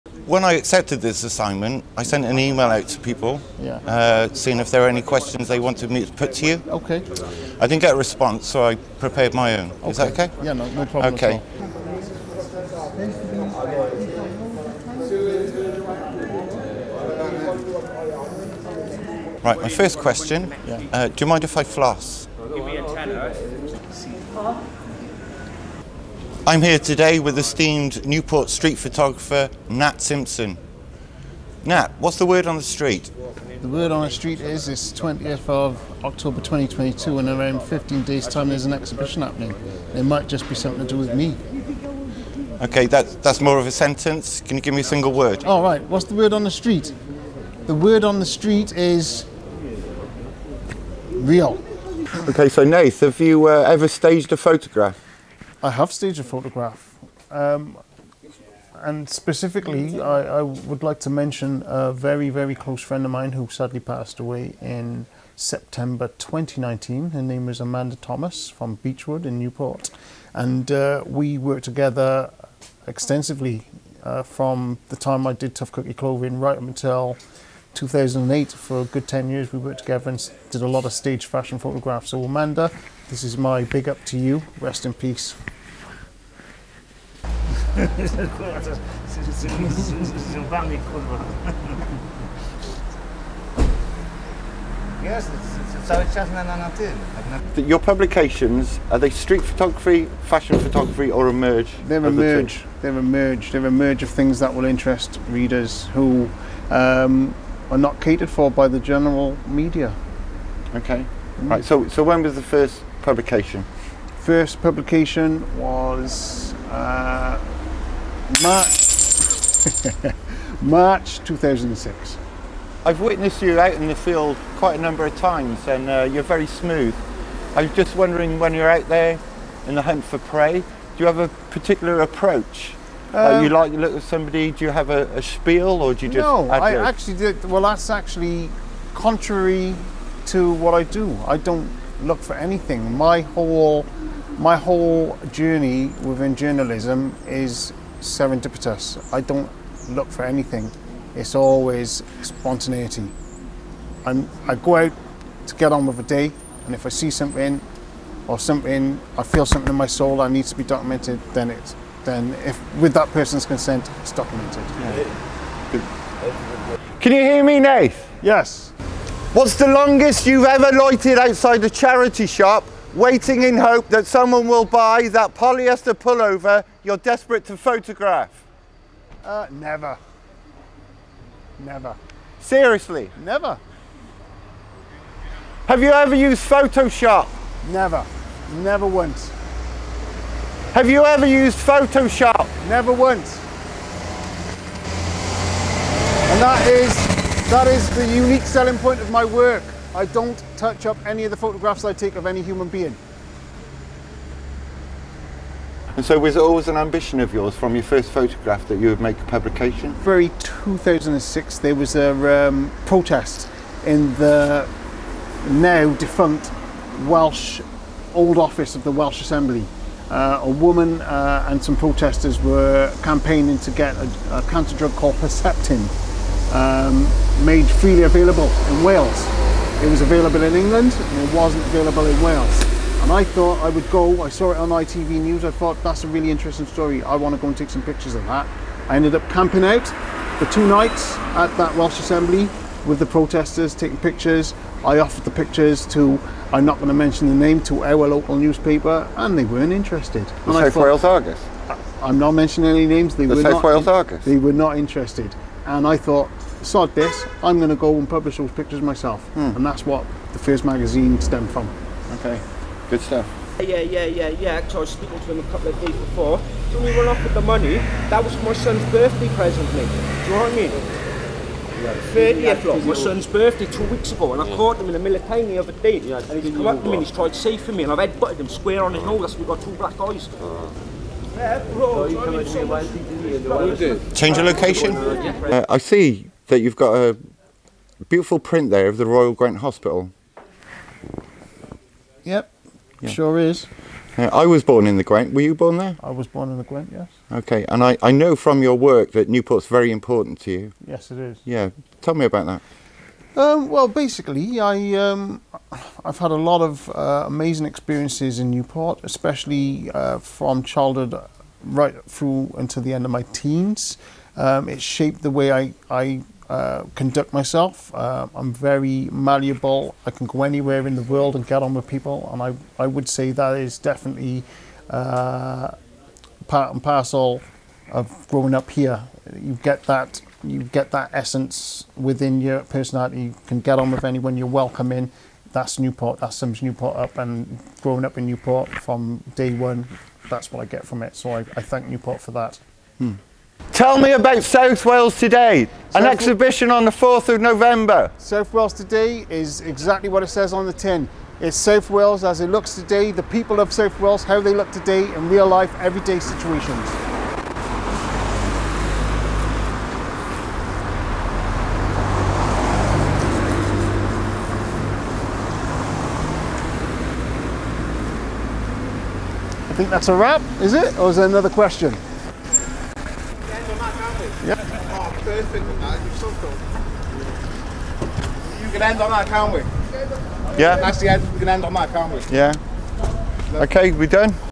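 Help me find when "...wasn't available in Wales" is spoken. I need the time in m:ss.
3:51.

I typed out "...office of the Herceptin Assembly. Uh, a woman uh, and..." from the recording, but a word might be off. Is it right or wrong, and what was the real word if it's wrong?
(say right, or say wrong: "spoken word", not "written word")
wrong: "Welsh", not "Herceptin".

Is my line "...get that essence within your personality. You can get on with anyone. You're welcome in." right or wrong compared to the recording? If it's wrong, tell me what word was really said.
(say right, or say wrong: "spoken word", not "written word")
right.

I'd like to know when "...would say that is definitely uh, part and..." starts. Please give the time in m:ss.
5:22.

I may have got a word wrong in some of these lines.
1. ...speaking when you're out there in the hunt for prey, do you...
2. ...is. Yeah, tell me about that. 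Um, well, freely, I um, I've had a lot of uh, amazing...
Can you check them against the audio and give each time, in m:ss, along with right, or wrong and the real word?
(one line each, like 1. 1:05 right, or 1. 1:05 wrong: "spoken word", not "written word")
1. 2:07 wrong: "wondering", not "speaking"
2. 5:01 wrong: "basically", not "freely".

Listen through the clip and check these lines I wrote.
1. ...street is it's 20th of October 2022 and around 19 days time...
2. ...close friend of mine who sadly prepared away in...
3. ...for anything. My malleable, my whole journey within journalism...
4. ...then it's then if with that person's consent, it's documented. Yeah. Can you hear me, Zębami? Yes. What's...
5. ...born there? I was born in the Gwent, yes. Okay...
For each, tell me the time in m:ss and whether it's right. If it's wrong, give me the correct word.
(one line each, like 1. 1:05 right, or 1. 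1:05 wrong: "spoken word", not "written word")
1. 0:34 wrong: "15", not "19"
2. 1:02 wrong: "passed", not "prepared"
3. 2:22 wrong: "whole", not "malleable"
4. 2:41 wrong: "Nath", not "Zębami"
5. 4:55 right.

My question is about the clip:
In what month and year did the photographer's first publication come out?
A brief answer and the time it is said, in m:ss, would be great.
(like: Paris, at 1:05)
March 2006, at 2:00.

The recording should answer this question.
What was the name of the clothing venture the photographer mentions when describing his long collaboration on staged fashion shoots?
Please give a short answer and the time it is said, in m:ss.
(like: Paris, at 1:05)
Tough Cookie Clothing, at 1:15.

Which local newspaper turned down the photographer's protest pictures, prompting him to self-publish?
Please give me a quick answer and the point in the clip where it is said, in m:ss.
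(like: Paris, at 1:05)
South Wales Argus, at 4:10.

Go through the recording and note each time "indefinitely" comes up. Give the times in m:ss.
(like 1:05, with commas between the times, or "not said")
not said.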